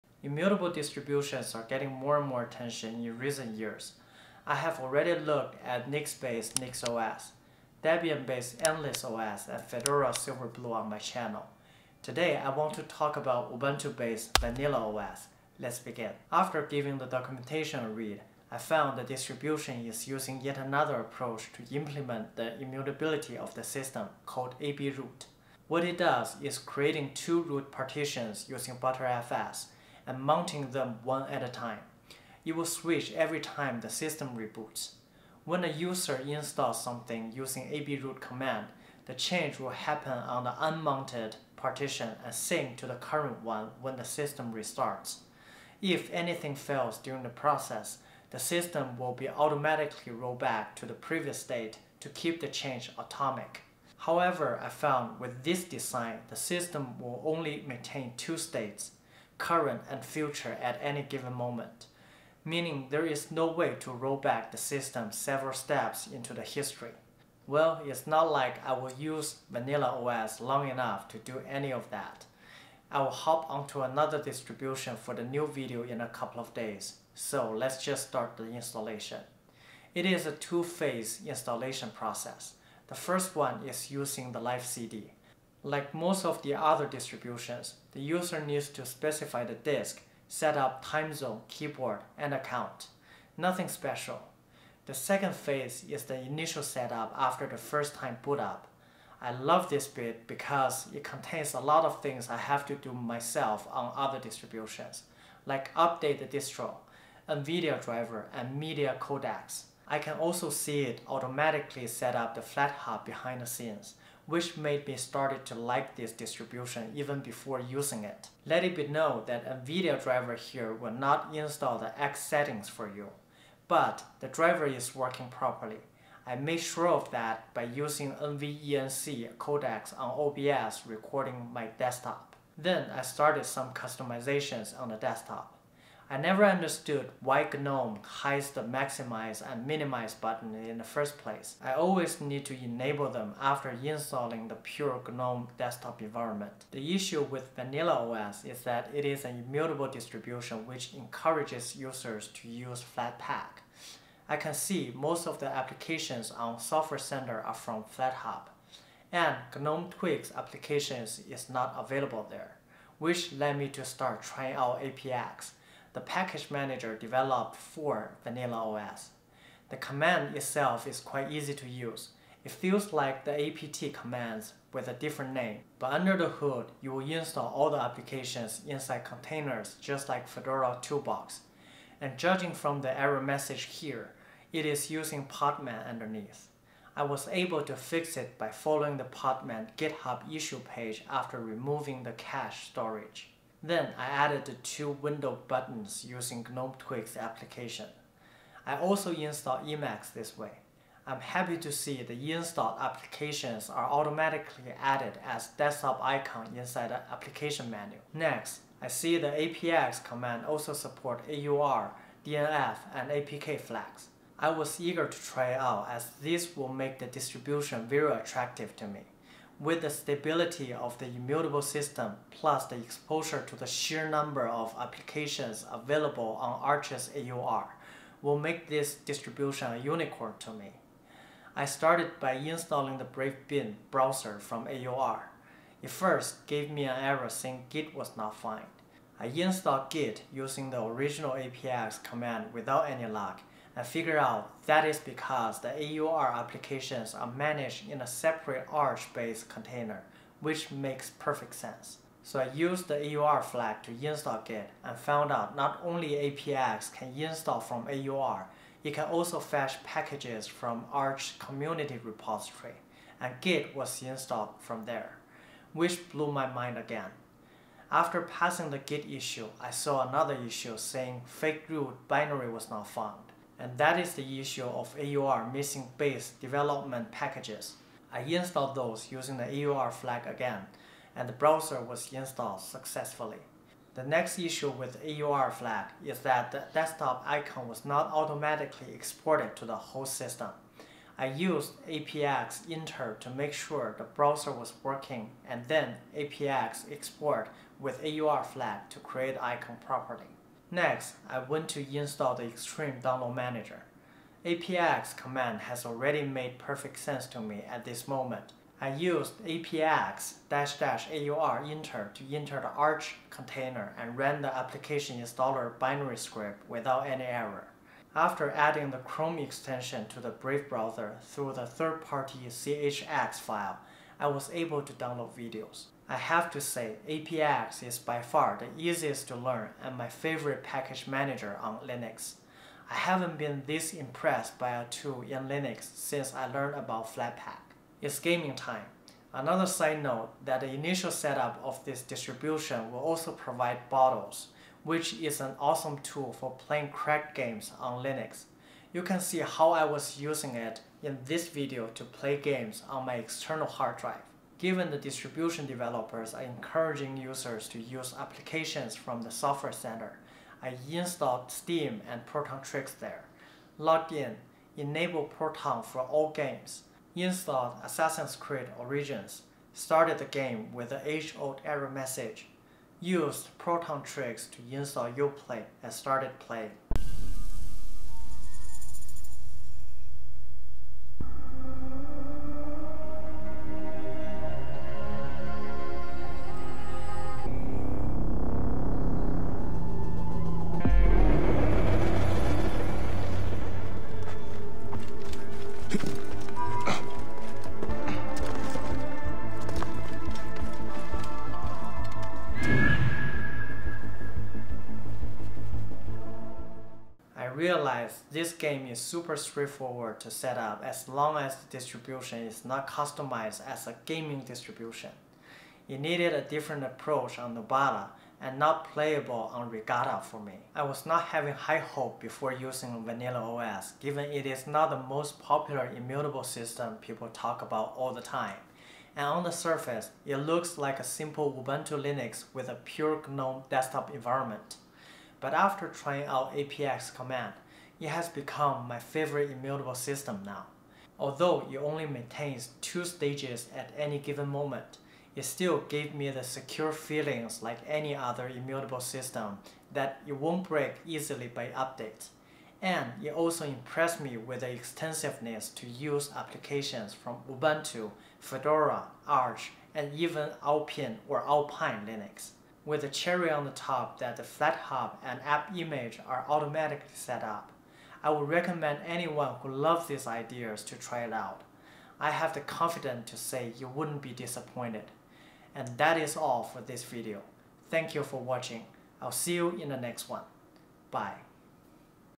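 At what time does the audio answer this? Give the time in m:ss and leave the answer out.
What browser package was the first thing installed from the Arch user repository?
3:53.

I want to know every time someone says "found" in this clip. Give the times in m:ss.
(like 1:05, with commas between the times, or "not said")
0:18, 0:54, 3:58, 4:14, 4:32.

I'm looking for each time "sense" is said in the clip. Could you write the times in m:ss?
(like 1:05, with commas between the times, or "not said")
4:11, 5:06.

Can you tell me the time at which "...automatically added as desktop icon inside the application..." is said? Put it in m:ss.
3:23.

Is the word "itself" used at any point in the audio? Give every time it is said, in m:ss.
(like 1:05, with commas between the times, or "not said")
2:50.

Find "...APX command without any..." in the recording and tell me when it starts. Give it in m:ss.
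4:01.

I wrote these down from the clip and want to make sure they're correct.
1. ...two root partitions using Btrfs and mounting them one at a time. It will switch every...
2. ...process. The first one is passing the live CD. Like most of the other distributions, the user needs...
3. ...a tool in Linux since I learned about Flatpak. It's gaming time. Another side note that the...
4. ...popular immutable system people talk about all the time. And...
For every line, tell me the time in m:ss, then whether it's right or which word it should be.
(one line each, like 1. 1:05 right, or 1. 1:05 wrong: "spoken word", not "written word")
1. 0:27 right
2. 1:21 wrong: "using", not "passing"
3. 5:34 right
4. 7:05 right.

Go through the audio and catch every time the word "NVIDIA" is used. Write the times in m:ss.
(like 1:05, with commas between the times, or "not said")
1:47, 1:59.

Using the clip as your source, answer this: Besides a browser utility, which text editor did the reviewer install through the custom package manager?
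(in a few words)
Emacs.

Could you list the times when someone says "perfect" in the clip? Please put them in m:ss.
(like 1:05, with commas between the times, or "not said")
4:11, 5:06.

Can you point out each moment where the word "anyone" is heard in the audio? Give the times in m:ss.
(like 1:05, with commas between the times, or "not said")
7:49.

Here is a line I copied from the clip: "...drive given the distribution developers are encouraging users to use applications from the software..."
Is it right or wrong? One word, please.
right.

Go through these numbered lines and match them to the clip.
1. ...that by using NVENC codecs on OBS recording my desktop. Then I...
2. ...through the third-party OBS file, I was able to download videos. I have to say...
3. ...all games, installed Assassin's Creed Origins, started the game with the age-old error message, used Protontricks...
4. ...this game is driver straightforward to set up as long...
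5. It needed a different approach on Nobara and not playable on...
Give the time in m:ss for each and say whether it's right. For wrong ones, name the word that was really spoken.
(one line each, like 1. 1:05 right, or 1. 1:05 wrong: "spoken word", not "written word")
1. 2:07 right
2. 5:21 wrong: "CHX", not "OBS"
3. 6:06 right
4. 6:48 wrong: "super", not "driver"
5. 6:55 right.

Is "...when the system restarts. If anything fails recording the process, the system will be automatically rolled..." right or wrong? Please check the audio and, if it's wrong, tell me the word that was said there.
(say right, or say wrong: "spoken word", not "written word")
wrong: "during", not "recording".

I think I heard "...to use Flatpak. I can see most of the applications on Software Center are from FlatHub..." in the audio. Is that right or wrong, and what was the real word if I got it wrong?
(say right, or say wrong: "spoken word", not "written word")
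right.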